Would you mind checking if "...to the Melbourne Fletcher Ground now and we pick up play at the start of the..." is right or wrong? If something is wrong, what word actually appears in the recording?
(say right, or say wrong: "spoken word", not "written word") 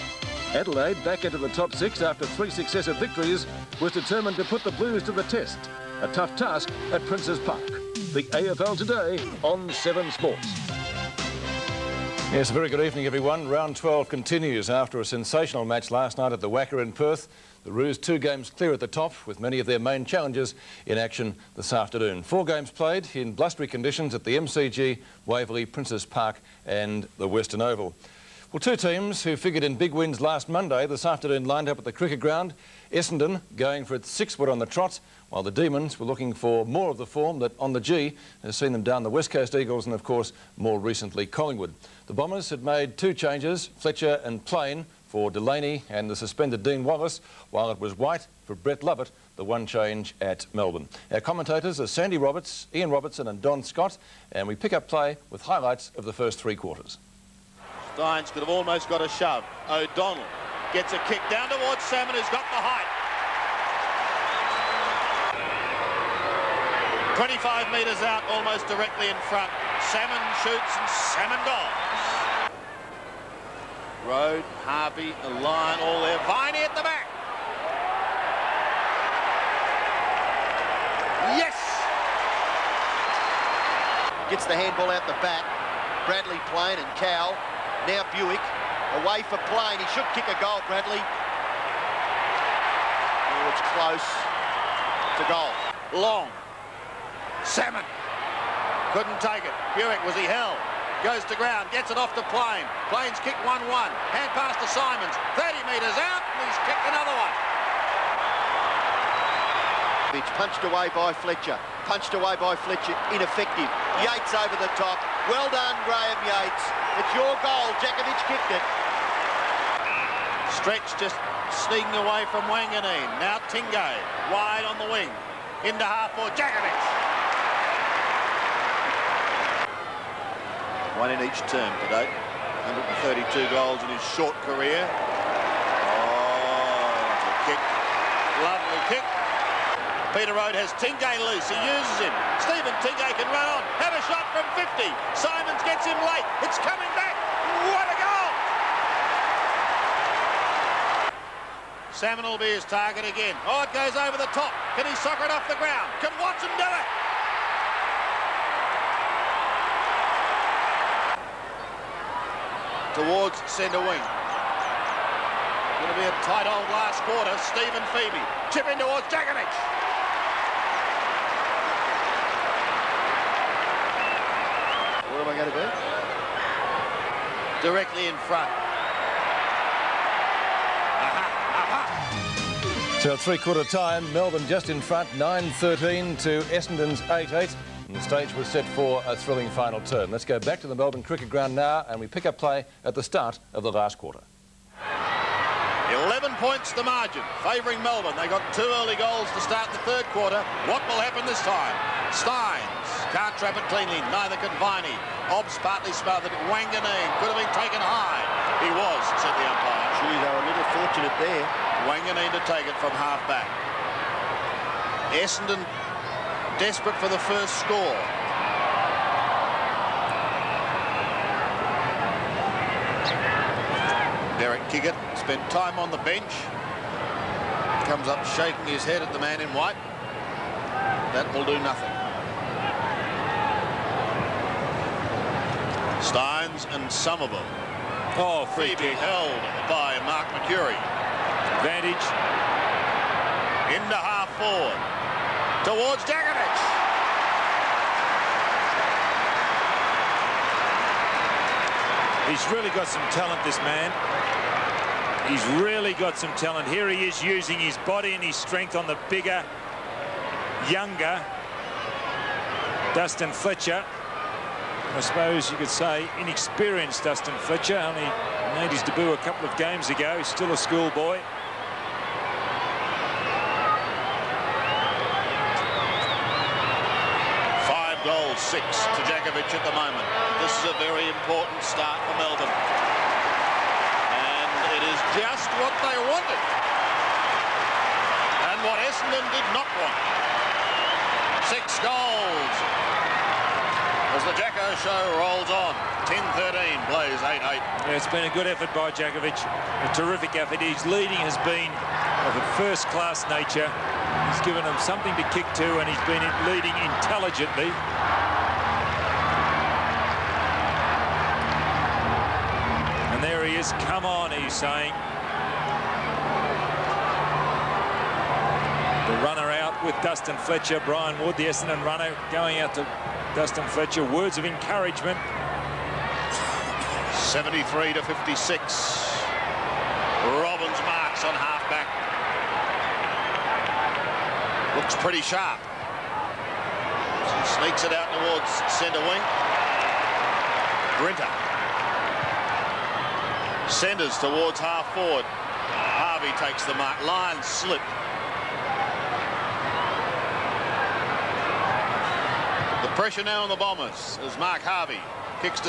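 wrong: "Cricket", not "Fletcher".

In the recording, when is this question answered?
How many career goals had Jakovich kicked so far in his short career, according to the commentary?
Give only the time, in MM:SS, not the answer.
02:13.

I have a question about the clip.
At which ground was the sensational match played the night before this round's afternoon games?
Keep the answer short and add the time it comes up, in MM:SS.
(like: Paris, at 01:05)
WACA, at 00:16.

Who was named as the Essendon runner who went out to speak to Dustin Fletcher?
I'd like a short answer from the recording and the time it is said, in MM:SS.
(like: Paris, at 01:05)
Brian Wood, at 05:20.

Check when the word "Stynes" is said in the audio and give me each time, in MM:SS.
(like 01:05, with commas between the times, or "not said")
03:22, 03:56.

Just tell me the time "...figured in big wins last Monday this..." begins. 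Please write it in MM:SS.
00:29.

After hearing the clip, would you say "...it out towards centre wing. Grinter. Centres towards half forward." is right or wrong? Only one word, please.
right.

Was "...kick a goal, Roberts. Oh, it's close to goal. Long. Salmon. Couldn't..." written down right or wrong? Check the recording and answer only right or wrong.
wrong.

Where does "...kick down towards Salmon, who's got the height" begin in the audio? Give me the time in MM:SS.
01:01.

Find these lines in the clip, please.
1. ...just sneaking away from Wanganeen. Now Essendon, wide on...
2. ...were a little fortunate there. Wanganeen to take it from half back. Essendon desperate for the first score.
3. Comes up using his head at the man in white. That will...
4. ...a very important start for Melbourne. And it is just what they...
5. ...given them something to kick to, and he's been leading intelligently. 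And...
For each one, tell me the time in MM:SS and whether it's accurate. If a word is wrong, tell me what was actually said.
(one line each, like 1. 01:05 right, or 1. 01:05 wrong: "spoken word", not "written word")
1. 02:01 wrong: "Tingay", not "Essendon"
2. 03:30 right
3. 03:47 wrong: "shaking", not "using"
4. 04:40 right
5. 05:04 right.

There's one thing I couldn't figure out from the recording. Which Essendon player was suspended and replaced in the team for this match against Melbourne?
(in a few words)
Dean Wallis.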